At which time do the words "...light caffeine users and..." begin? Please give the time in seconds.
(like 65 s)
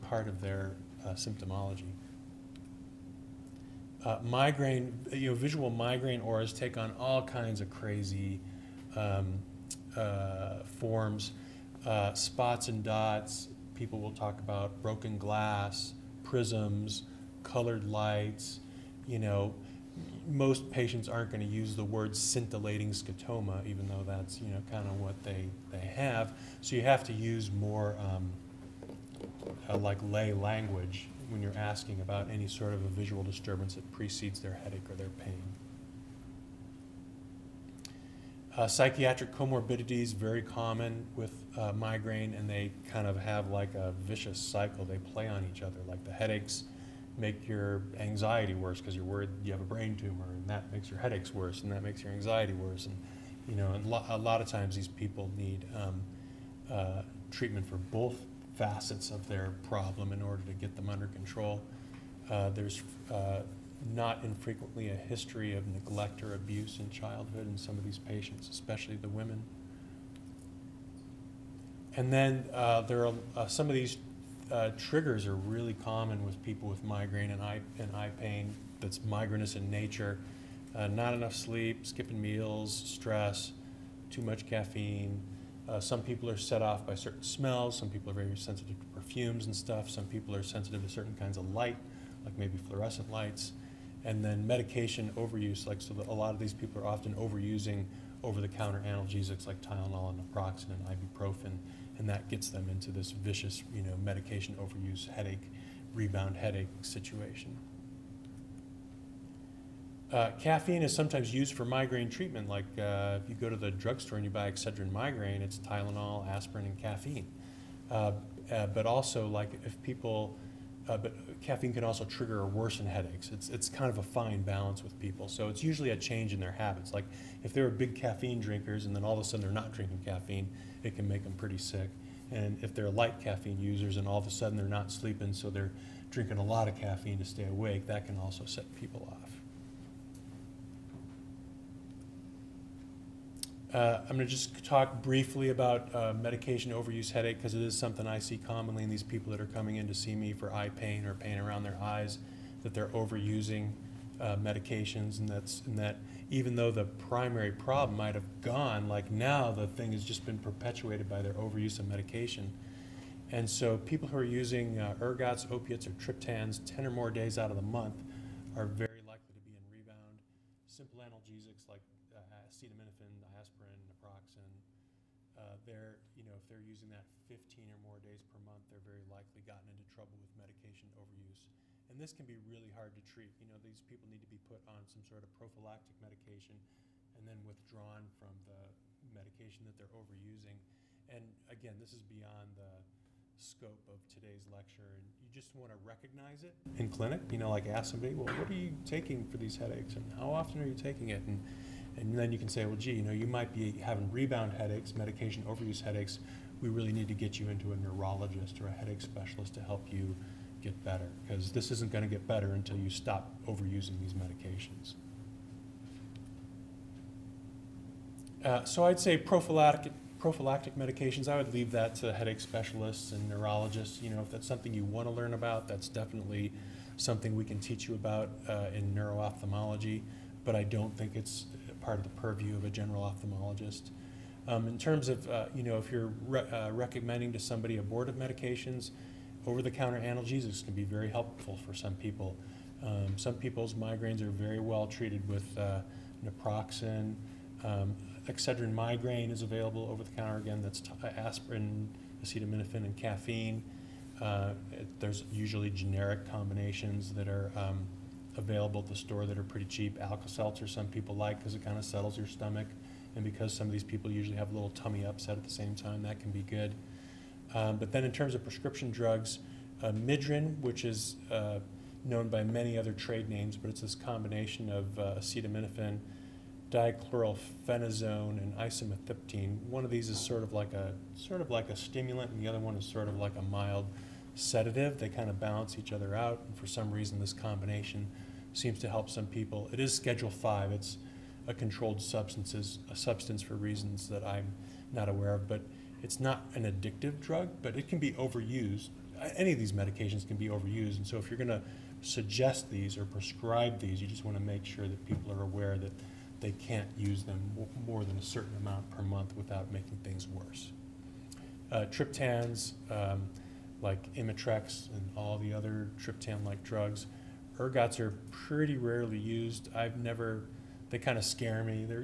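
132 s.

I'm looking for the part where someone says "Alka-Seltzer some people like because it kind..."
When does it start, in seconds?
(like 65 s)
260 s.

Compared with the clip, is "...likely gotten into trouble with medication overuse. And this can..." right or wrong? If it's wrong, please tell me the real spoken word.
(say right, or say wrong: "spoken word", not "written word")
right.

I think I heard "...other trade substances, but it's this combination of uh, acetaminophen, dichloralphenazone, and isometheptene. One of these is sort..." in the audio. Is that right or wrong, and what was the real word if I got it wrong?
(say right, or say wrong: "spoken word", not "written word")
wrong: "names", not "substances".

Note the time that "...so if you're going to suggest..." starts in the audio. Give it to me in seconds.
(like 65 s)
301 s.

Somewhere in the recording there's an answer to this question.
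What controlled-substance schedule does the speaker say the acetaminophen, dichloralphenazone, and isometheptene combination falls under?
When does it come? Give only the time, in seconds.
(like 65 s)
289 s.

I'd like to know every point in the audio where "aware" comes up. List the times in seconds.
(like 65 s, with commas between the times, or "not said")
295 s, 305 s.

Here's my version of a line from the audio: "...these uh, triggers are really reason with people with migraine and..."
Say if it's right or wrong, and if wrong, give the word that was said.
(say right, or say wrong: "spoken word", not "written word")
wrong: "common", not "reason".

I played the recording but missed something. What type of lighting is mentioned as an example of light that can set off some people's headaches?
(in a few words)
fluorescent lights.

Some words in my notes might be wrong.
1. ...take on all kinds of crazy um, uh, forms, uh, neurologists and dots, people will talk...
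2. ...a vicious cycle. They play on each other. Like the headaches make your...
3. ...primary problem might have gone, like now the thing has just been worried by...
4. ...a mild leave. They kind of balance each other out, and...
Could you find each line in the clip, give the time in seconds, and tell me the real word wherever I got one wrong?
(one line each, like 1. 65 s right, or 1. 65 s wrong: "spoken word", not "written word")
1. 6 s wrong: "spots", not "neurologists"
2. 43 s right
3. 156 s wrong: "perpetuated", not "worried"
4. 283 s wrong: "sedative", not "leave".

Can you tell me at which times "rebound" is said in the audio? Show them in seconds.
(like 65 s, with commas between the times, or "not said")
105 s, 169 s, 204 s.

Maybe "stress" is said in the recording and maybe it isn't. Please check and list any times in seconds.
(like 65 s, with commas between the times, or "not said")
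82 s.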